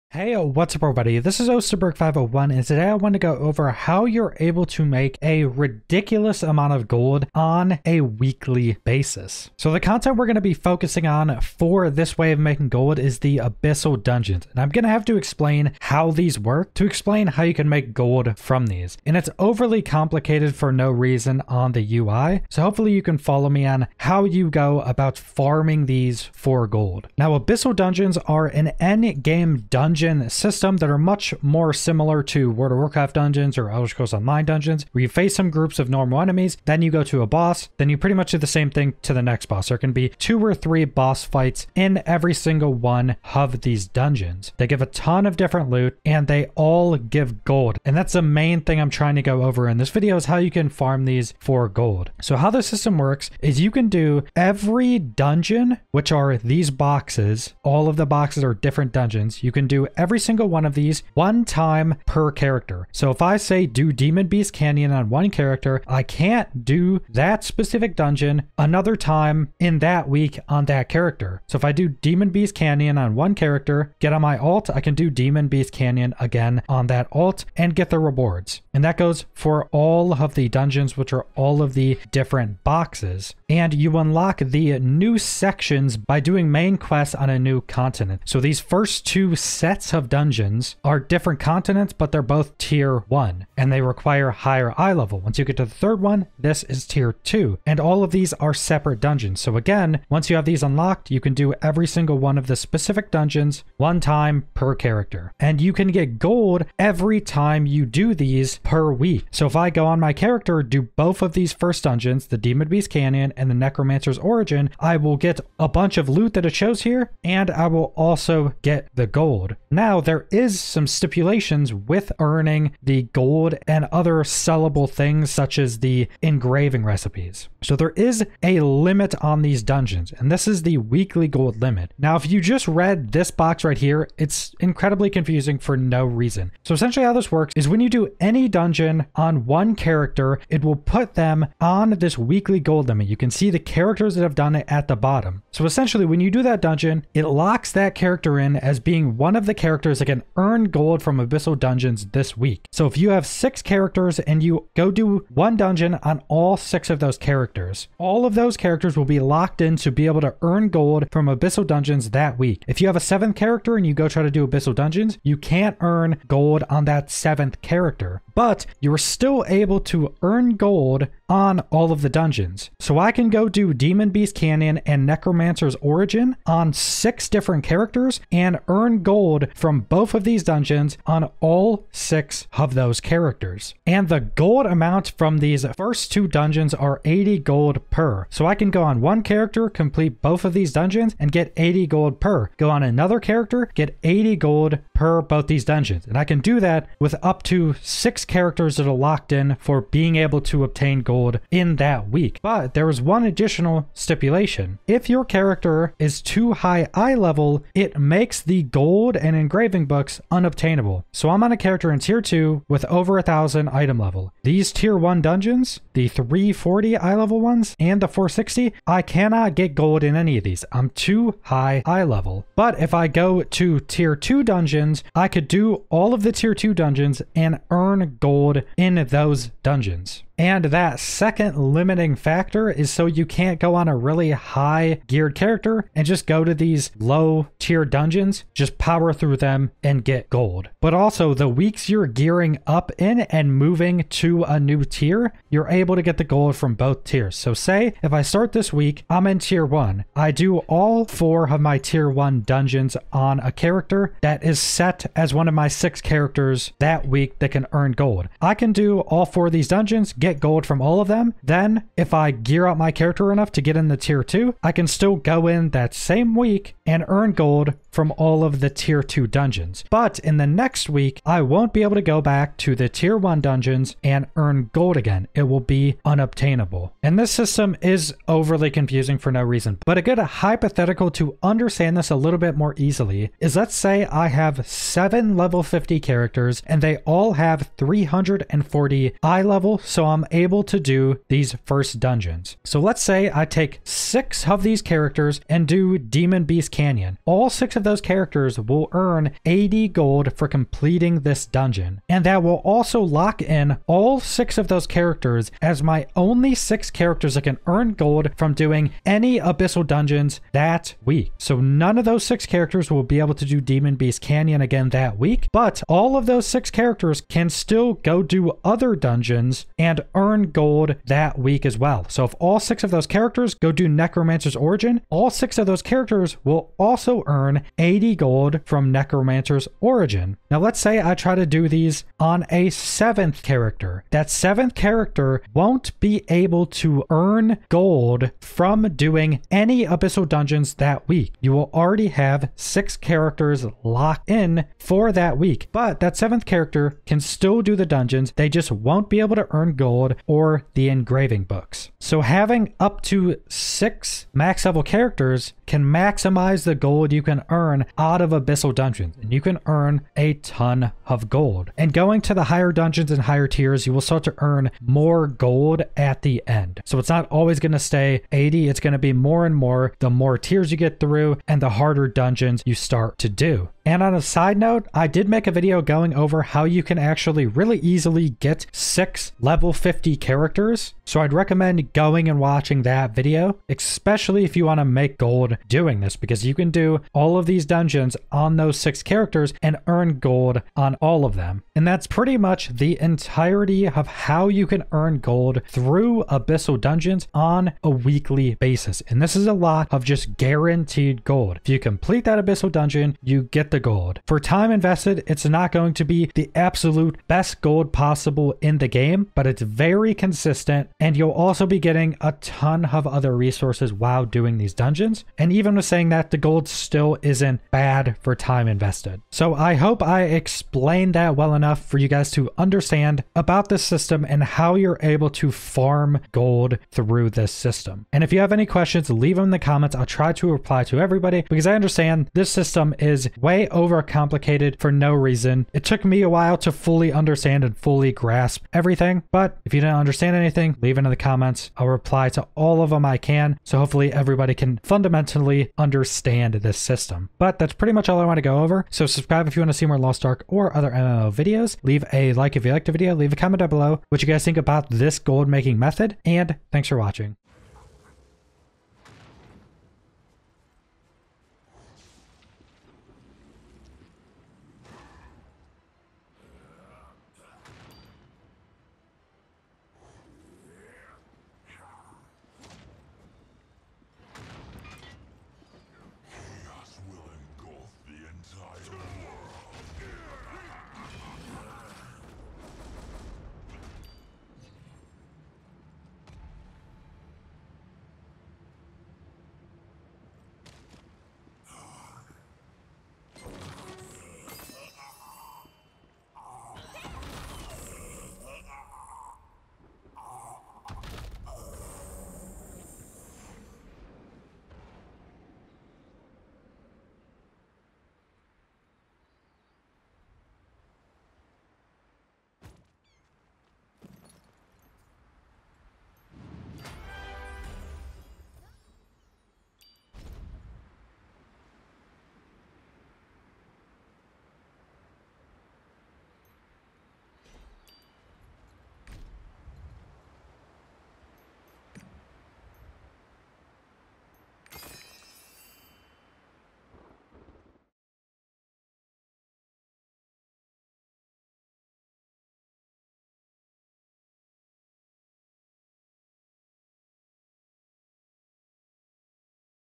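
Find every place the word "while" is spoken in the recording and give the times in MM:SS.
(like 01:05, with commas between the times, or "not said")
06:53, 07:16.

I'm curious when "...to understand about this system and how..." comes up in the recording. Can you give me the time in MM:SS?
07:02.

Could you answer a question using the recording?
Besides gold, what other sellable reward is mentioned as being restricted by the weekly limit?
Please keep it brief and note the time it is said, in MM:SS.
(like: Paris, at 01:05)
engraving recipes, at 02:06.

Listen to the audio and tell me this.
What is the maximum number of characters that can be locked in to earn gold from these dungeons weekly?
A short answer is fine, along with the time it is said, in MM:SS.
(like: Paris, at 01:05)
6, at 06:18.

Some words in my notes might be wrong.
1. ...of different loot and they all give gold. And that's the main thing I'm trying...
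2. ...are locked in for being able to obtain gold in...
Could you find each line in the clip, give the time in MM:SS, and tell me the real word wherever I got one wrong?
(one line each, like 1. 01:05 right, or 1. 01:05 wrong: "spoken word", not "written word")
1. 00:45 right
2. 03:18 right.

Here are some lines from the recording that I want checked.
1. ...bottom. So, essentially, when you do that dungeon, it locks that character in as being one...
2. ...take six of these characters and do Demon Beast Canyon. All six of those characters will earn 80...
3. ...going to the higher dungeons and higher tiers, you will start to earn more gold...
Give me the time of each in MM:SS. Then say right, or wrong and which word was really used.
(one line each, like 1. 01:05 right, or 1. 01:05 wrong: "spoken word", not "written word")
1. 02:24 right
2. 04:53 right
3. 06:01 right.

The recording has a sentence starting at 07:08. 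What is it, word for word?
And if you have any questions, leave them in the comments.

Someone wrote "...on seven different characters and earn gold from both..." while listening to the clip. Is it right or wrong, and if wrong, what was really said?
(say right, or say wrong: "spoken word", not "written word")
wrong: "six", not "seven".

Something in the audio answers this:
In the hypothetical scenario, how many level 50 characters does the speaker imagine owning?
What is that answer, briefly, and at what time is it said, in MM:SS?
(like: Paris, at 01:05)
7, at 04:44.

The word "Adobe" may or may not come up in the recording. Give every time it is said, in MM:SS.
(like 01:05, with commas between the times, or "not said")
not said.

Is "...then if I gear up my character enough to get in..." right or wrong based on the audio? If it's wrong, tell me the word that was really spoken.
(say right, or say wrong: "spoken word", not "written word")
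right.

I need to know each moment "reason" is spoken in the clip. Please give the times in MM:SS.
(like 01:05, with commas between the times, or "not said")
00:20, 02:16, 04:39, 07:15.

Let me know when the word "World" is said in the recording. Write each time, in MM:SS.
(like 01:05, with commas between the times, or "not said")
00:32.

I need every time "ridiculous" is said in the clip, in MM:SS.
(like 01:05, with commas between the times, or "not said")
00:05.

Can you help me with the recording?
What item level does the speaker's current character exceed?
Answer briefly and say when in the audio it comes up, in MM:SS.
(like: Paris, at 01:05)
1000, at 03:33.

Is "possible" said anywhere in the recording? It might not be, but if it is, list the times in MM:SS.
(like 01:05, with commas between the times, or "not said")
06:47.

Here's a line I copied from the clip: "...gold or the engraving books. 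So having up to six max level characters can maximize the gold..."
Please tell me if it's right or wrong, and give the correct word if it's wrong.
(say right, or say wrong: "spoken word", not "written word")
right.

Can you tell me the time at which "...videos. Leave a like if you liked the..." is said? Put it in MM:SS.
07:31.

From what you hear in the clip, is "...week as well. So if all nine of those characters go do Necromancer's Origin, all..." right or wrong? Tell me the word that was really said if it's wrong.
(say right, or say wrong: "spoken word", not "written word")
wrong: "six", not "nine".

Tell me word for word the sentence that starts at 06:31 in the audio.
And that's pretty much the entirety of how you can earn gold through Abyssal Dungeons on a weekly basis.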